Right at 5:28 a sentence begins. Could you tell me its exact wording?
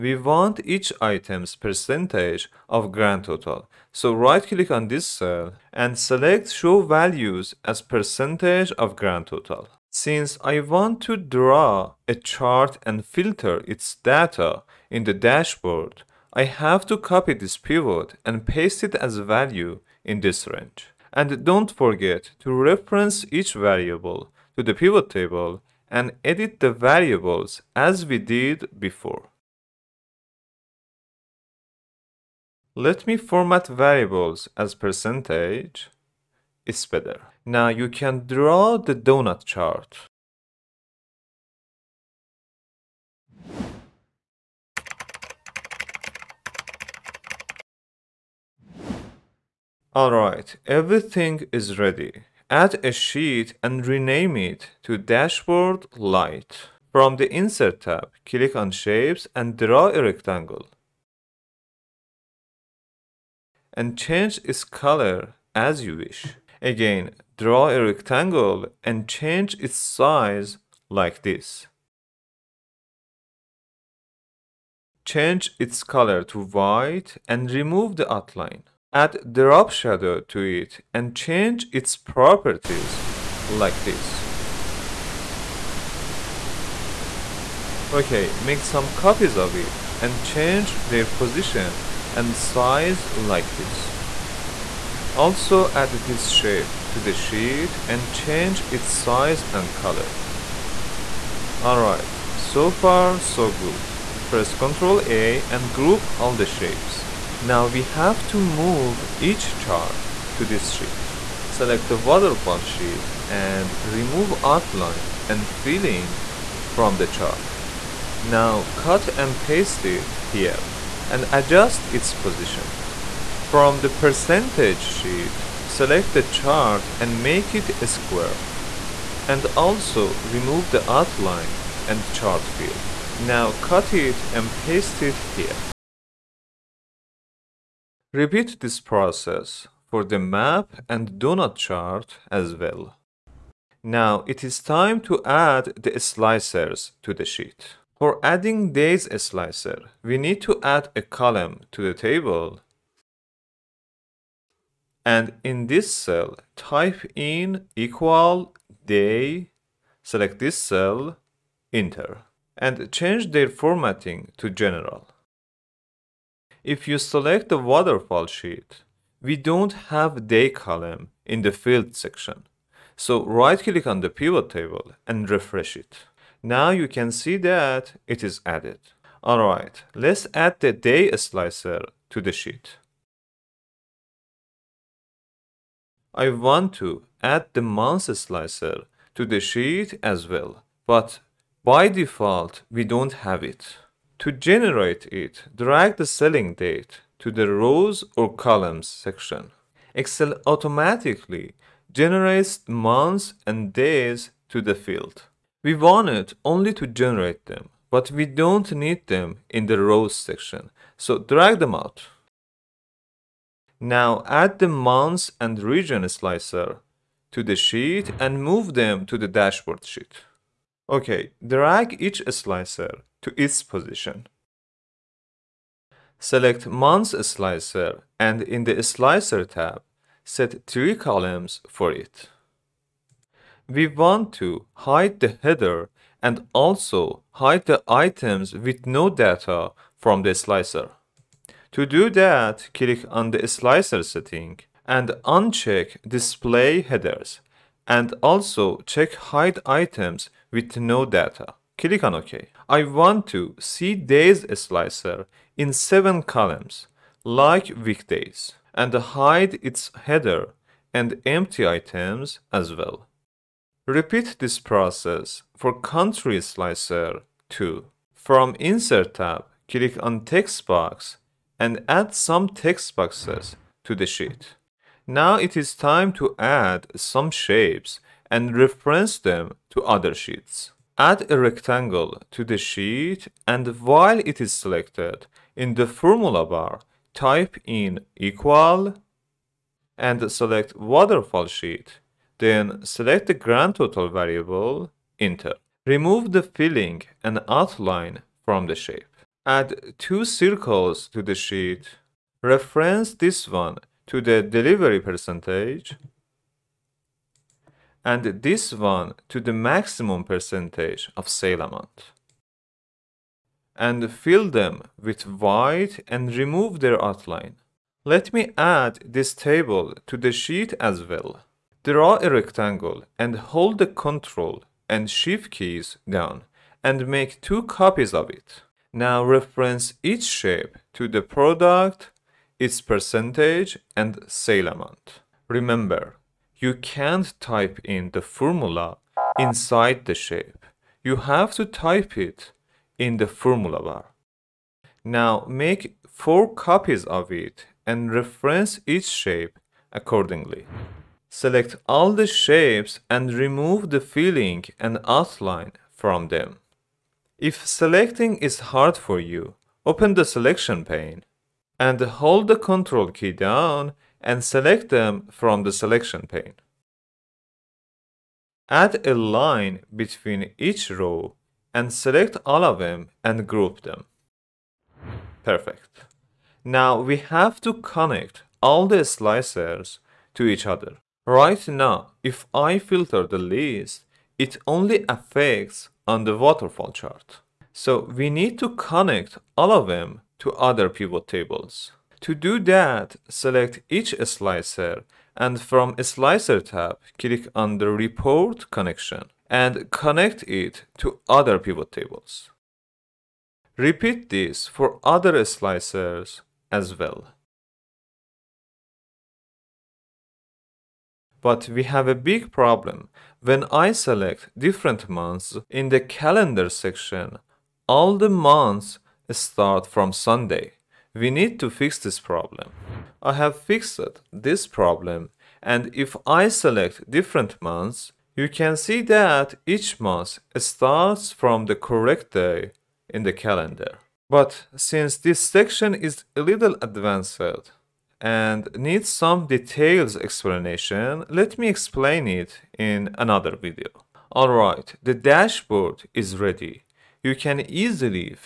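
Now reference each shape to the product, its percentage and sale amount.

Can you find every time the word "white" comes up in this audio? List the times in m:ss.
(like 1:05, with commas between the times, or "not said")
1:16, 5:15.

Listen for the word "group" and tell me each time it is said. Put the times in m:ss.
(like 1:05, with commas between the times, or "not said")
1:45, 6:13.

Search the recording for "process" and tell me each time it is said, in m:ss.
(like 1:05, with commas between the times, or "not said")
2:18, 4:24.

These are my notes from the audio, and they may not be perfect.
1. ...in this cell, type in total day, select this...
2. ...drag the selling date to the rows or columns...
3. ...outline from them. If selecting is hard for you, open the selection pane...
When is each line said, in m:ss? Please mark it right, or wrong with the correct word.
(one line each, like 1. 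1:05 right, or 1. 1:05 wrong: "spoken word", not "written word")
1. 2:35 wrong: "equal", not "total"
2. 3:15 right
3. 5:55 right.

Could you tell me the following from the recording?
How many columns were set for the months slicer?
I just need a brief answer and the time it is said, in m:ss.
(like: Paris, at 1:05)
3, at 3:50.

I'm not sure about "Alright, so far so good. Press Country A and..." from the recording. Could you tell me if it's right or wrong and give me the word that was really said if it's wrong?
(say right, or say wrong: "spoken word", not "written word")
wrong: "Ctrl", not "Country".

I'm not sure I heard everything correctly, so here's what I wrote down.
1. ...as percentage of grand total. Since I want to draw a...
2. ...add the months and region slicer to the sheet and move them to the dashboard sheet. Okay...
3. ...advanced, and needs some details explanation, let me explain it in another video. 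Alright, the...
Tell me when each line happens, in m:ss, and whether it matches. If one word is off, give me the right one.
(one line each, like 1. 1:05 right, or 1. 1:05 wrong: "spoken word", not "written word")
1. 0:07 right
2. 3:34 right
3. 7:16 right.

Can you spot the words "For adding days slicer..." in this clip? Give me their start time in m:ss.
2:28.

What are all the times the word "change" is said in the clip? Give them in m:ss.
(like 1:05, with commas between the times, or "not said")
1:03, 1:09, 1:15, 1:21, 1:30, 1:38, 2:42.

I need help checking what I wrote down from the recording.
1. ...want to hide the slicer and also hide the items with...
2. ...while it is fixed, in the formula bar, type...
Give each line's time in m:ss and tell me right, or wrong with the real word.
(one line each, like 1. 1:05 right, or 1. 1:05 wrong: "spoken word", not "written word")
1. 3:53 wrong: "header", not "slicer"
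2. 4:43 wrong: "selected", not "fixed".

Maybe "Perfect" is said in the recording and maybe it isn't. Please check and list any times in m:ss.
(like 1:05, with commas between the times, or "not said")
6:15.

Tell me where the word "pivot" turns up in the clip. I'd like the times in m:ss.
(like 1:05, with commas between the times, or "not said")
0:17, 0:24, 2:54, 6:30, 6:41.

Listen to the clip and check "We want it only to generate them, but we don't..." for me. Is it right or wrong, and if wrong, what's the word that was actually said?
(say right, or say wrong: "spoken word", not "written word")
right.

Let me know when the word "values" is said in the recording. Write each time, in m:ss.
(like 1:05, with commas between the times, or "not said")
0:06, 0:19.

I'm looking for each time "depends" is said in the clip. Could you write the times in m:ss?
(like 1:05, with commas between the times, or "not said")
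not said.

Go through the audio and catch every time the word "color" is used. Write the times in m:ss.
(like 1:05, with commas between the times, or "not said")
1:04, 1:15, 1:39.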